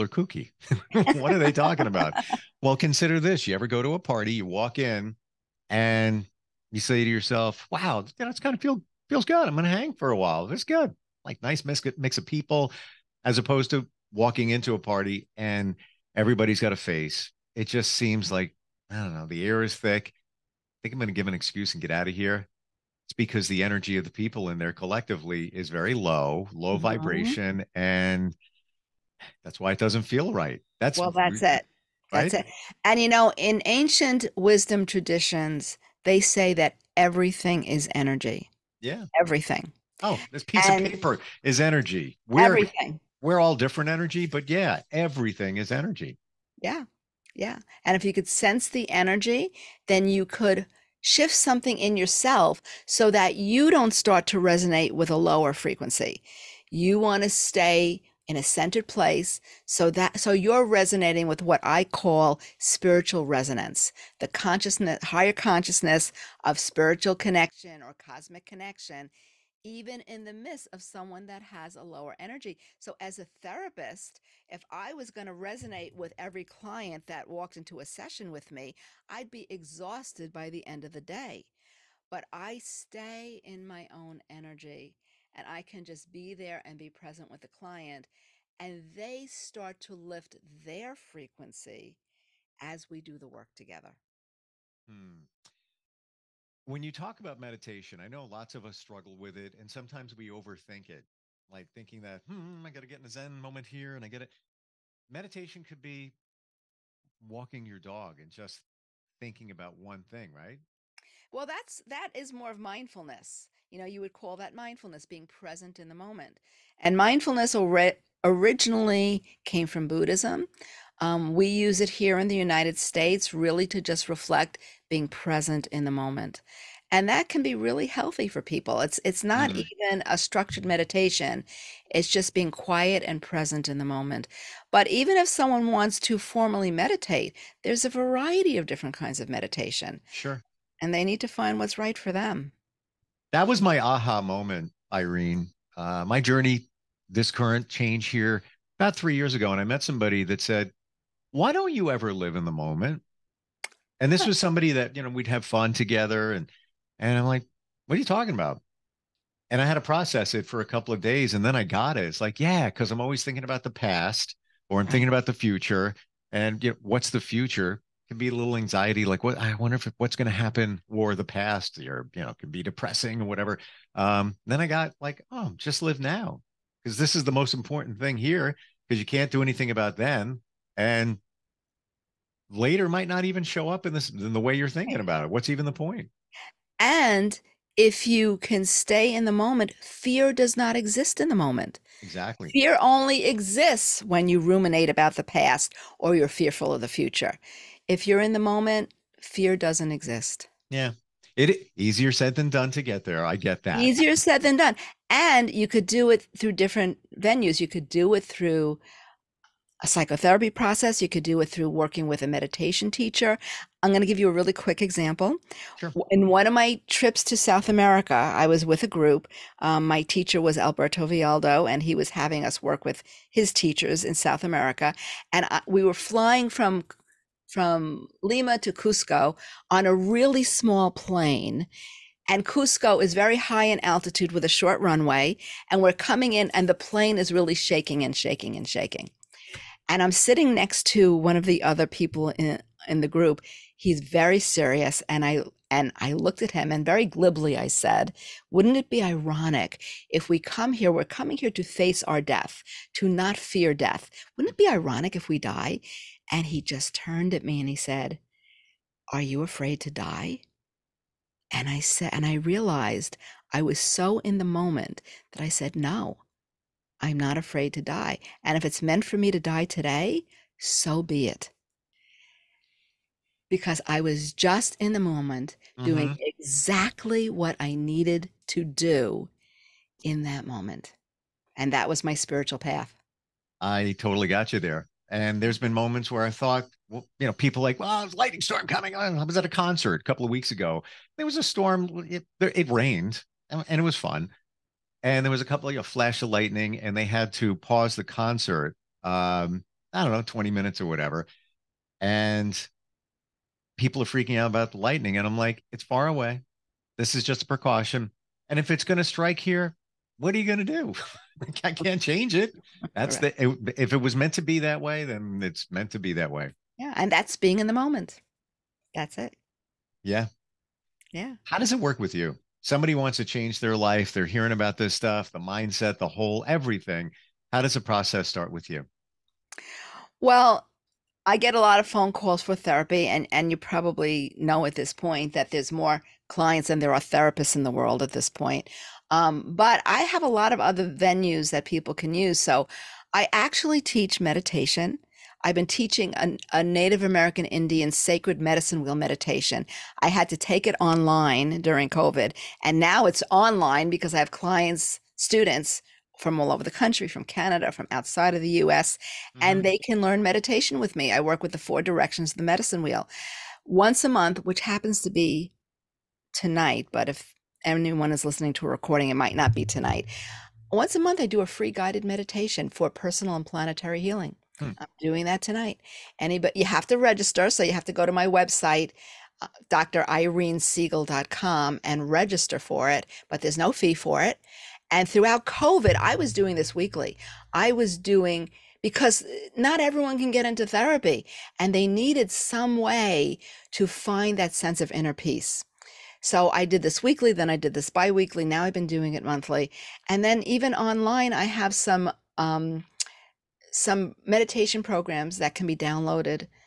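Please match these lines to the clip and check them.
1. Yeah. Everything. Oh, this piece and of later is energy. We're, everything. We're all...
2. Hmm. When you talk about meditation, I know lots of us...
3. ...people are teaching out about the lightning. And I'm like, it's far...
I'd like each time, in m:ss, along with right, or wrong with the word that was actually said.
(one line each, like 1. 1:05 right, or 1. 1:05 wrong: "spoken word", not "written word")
1. 0:38 wrong: "paper", not "later"
2. 1:34 right
3. 5:03 wrong: "freaking", not "teaching".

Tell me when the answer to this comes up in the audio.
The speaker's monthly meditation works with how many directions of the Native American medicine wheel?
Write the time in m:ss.
6:01.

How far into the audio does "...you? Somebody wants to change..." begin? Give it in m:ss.
5:22.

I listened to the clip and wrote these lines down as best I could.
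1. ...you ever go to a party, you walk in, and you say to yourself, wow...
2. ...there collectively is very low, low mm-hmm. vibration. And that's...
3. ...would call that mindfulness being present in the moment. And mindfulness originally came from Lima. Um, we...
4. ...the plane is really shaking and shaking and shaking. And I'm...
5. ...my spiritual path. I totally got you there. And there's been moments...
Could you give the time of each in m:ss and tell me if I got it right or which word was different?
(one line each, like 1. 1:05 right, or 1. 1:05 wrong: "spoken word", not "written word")
1. 0:03 right
2. 0:24 right
3. 1:54 wrong: "Buddhism", not "Lima"
4. 3:56 right
5. 4:42 right.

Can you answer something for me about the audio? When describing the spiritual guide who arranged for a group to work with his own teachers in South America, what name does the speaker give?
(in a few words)
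Alberto Villoldo.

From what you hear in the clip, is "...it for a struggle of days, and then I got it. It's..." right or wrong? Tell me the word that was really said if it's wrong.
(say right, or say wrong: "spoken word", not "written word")
wrong: "couple", not "struggle".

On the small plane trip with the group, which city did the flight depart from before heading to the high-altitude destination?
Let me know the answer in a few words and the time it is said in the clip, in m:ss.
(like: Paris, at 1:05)
Lima, at 3:48.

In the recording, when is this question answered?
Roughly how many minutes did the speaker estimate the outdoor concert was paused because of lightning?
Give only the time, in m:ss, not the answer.
5:00.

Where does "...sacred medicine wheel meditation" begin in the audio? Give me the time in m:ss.
5:47.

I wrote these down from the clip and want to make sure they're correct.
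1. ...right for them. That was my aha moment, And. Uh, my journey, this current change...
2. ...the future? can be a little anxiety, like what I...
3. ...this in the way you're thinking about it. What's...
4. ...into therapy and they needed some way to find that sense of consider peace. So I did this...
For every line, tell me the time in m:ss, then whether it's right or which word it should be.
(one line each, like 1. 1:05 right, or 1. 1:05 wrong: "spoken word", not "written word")
1. 2:21 wrong: "Irene", not "And"
2. 2:47 right
3. 3:03 right
4. 6:30 wrong: "inner", not "consider".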